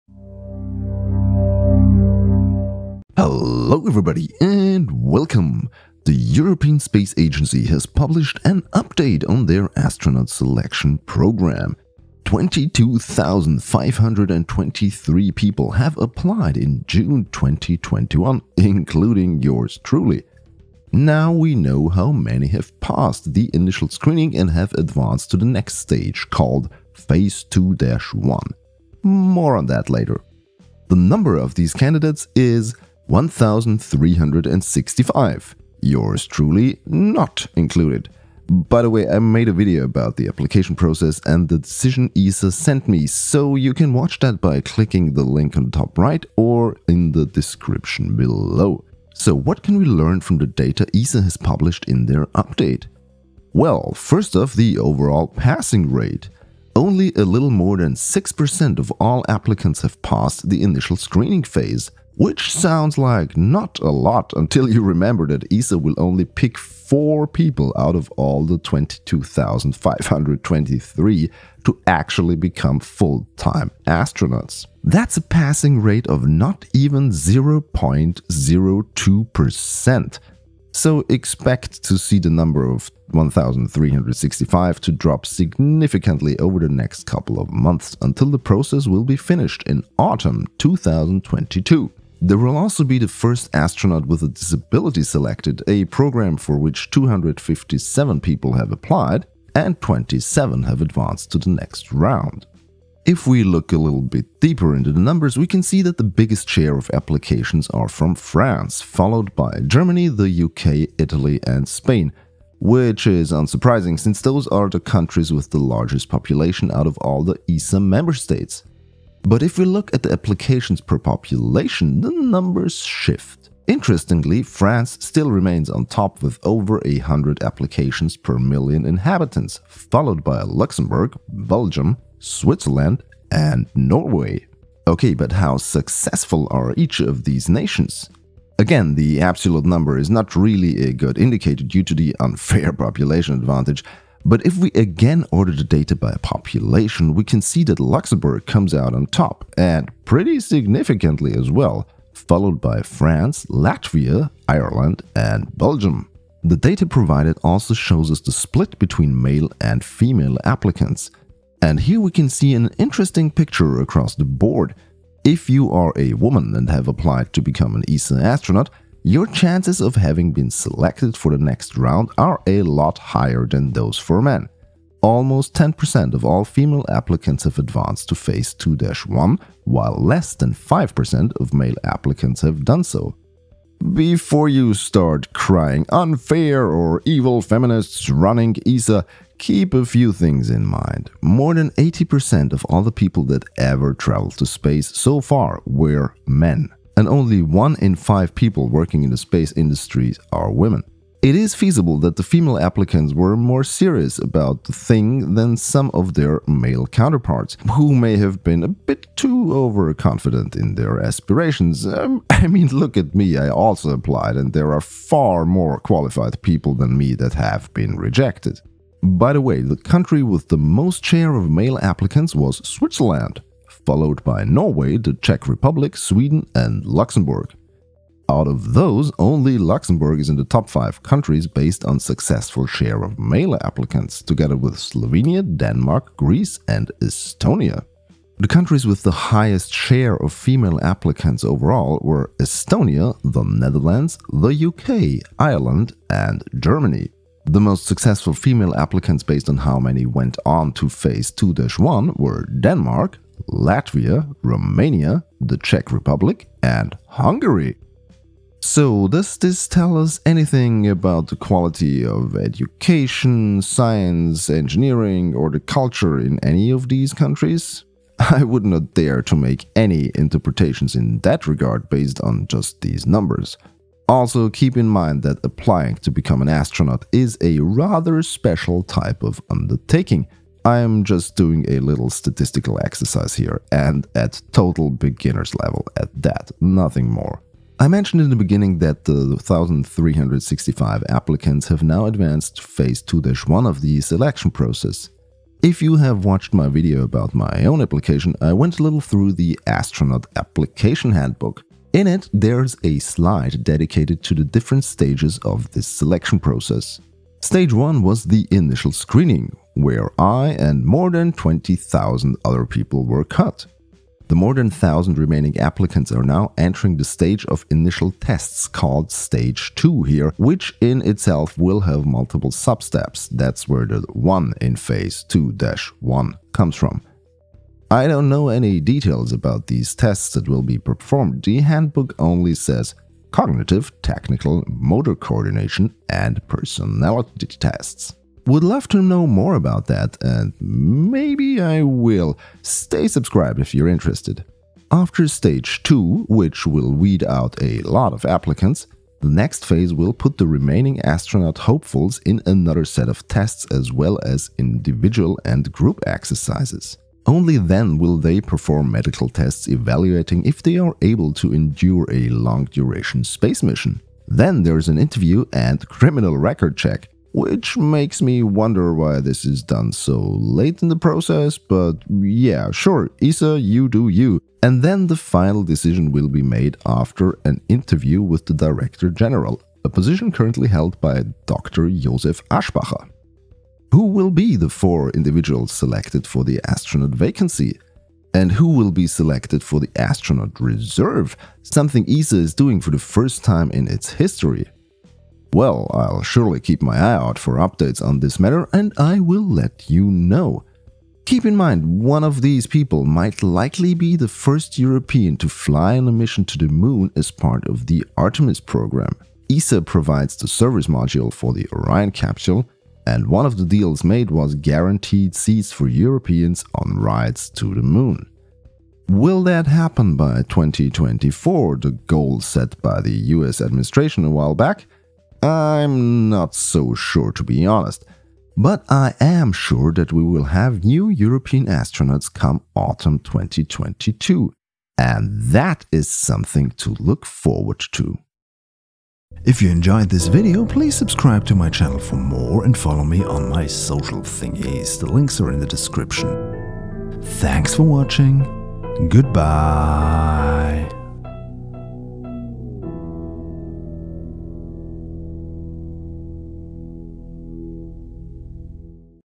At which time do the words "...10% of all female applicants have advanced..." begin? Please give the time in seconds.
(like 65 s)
175 s.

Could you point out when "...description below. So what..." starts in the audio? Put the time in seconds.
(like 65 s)
47 s.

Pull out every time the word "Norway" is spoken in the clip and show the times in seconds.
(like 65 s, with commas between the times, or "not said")
133 s, 224 s.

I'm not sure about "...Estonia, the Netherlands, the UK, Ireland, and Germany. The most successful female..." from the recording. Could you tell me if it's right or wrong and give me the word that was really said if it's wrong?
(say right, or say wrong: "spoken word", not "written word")
right.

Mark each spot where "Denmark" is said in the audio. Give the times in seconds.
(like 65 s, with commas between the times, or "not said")
235 s, 252 s.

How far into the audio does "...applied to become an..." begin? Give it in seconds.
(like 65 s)
166 s.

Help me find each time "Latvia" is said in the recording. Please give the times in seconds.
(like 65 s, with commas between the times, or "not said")
153 s, 253 s.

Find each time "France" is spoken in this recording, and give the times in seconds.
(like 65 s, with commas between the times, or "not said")
108 s, 124 s, 152 s.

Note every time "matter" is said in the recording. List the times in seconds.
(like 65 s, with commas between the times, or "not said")
398 s.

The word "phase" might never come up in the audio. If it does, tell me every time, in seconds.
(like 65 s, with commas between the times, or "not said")
26 s, 61 s, 178 s, 250 s, 292 s, 324 s, 349 s.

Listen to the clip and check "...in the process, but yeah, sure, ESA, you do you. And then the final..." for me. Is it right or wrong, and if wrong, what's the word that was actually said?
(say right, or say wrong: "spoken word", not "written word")
right.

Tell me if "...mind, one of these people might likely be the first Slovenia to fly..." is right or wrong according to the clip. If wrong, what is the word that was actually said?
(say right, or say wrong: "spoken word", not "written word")
wrong: "European", not "Slovenia".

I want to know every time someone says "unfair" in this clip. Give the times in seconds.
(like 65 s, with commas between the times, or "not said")
142 s, 185 s.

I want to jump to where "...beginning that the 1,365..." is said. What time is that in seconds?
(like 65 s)
288 s.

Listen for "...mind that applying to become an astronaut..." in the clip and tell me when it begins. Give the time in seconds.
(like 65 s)
274 s.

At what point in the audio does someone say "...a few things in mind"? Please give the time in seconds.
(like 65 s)
189 s.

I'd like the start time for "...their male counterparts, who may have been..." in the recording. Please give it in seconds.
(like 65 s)
206 s.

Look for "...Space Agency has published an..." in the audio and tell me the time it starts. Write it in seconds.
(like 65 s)
6 s.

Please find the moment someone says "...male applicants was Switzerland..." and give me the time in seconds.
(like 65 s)
221 s.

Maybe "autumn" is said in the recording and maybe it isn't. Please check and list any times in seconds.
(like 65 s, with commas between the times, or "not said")
89 s, 432 s.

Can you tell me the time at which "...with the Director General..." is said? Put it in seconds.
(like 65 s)
378 s.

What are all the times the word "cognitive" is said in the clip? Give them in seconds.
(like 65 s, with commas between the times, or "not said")
333 s.